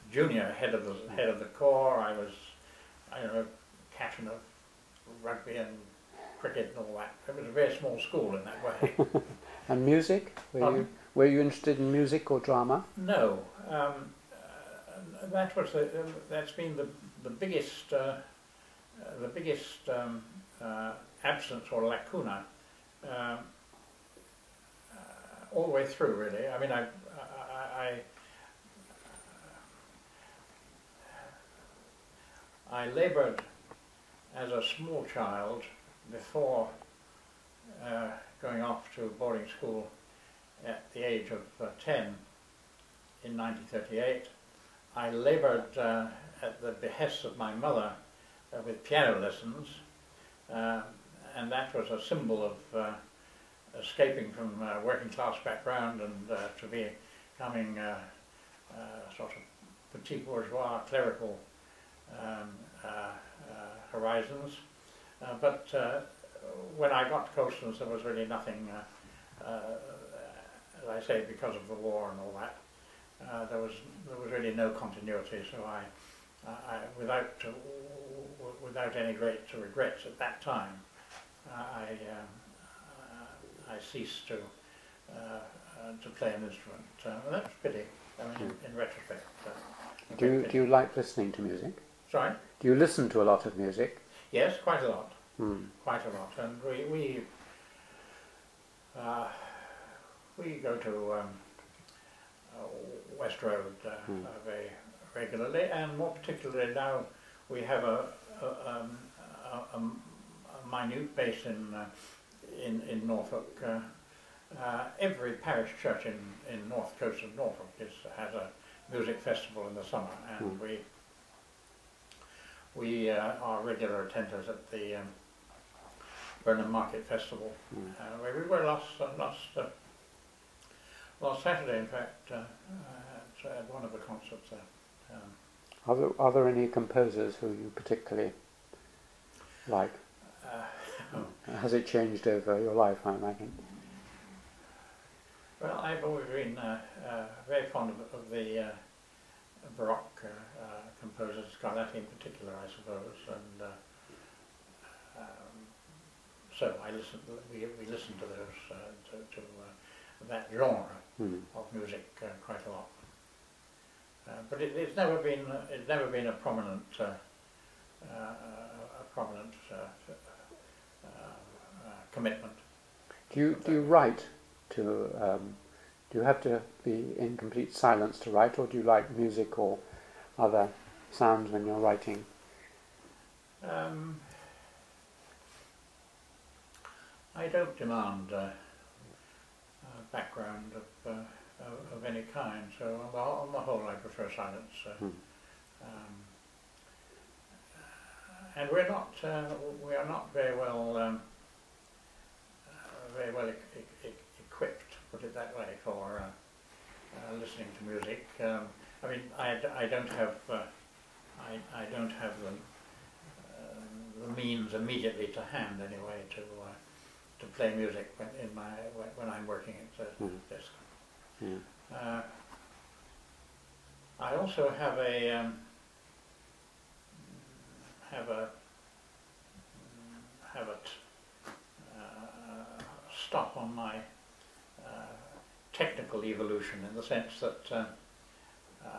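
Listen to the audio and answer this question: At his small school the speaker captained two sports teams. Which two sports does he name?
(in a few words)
rugby and cricket.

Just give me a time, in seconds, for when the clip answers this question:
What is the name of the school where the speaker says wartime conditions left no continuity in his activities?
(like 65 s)
67 s.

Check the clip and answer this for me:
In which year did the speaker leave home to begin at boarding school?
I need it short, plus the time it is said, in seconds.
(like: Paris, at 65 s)
1938, at 43 s.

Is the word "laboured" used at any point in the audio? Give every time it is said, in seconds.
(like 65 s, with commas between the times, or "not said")
32 s, 45 s.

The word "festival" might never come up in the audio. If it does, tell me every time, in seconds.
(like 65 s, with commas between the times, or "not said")
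119 s, 127 s.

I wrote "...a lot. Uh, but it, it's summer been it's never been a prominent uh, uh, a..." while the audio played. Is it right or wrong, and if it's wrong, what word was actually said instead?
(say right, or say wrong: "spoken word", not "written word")
wrong: "never", not "summer".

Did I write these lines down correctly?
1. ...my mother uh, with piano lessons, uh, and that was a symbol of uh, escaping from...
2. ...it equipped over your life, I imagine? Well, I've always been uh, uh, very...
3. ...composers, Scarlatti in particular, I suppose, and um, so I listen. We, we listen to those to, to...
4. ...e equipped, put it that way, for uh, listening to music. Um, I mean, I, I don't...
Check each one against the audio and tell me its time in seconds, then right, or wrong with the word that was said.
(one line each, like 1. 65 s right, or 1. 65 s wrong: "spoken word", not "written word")
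1. 47 s right
2. 141 s wrong: "changed", not "equipped"
3. 150 s right
4. 204 s right.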